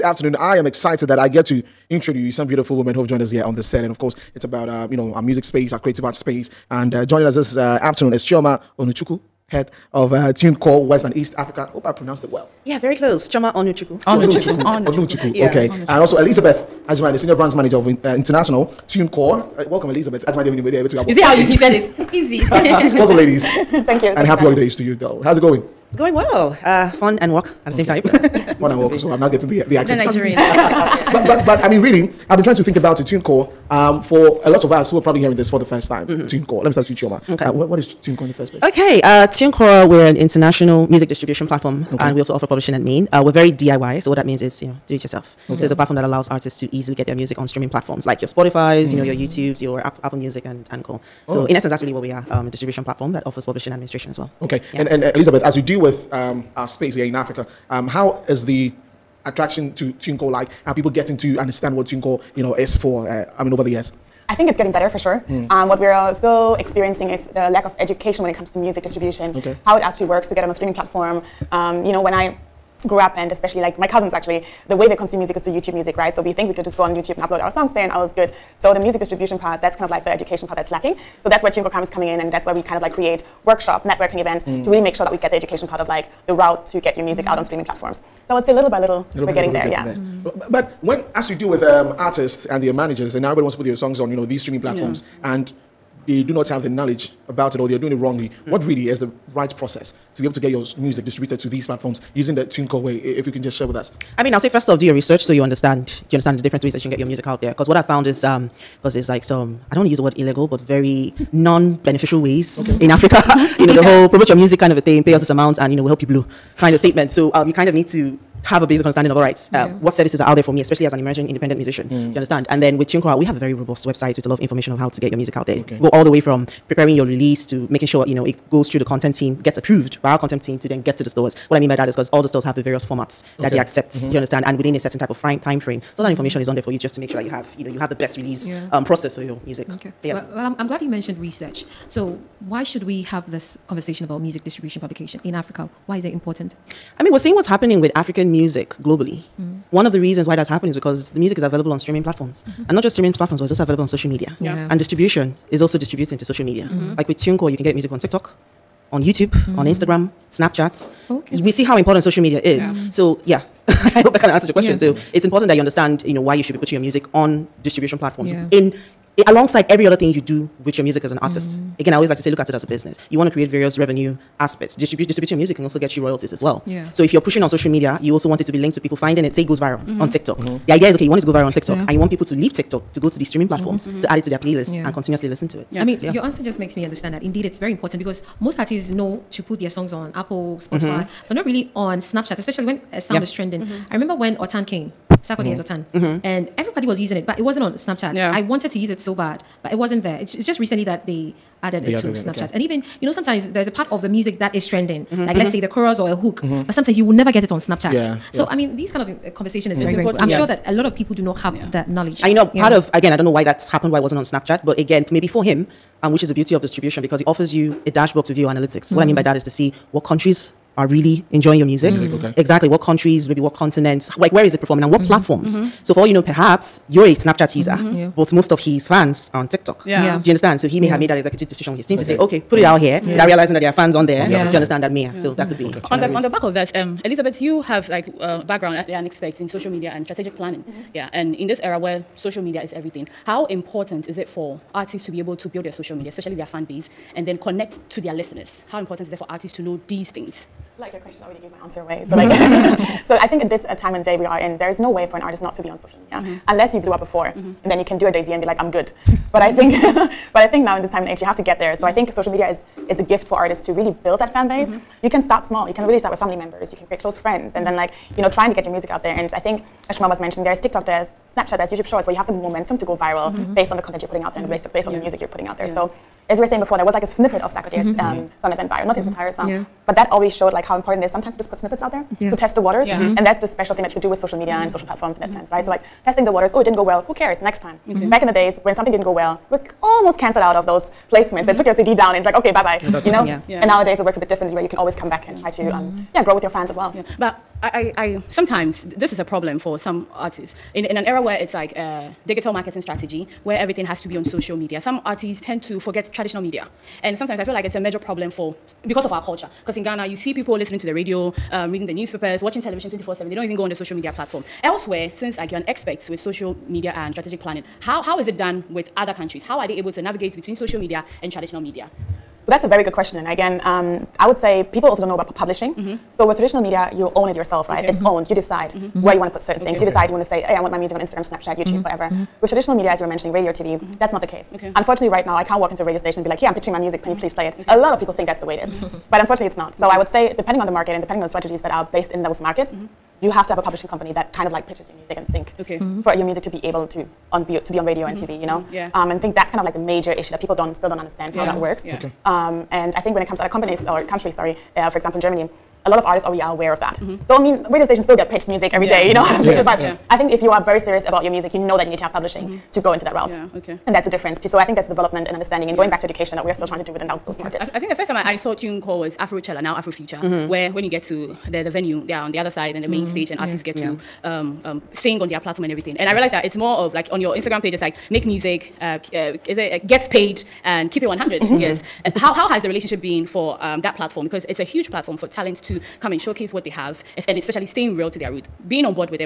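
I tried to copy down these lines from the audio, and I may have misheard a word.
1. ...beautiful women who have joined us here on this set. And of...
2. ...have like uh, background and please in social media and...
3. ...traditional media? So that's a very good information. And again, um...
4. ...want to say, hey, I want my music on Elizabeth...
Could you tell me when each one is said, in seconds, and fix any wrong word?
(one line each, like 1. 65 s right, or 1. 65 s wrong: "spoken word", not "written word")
1. 2 s right
2. 237 s wrong: "expertise", not "please"
3. 321 s wrong: "question", not "information"
4. 330 s wrong: "Instagram", not "Elizabeth".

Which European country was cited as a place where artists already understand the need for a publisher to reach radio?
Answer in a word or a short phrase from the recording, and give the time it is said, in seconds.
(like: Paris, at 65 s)
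Germany, at 355 s.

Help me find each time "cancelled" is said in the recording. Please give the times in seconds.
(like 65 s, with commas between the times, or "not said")
290 s.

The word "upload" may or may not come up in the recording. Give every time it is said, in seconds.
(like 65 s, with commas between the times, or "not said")
77 s.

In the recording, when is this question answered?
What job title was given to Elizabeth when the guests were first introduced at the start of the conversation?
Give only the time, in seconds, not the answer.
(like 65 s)
17 s.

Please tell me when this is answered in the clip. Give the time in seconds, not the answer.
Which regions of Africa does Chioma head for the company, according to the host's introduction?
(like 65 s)
10 s.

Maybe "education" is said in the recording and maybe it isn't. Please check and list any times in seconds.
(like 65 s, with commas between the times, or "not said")
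67 s, 80 s, 85 s, 366 s.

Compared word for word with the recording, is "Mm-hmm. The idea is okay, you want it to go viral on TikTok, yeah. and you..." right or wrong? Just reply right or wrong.
right.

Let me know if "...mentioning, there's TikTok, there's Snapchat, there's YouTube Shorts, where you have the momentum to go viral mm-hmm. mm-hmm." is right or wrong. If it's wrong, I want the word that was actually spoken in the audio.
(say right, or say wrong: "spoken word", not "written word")
right.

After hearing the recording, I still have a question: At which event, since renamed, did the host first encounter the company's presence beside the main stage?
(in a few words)
Afrochella.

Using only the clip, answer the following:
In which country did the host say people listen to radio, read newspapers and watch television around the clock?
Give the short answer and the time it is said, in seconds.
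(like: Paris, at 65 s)
Ghana, at 309 s.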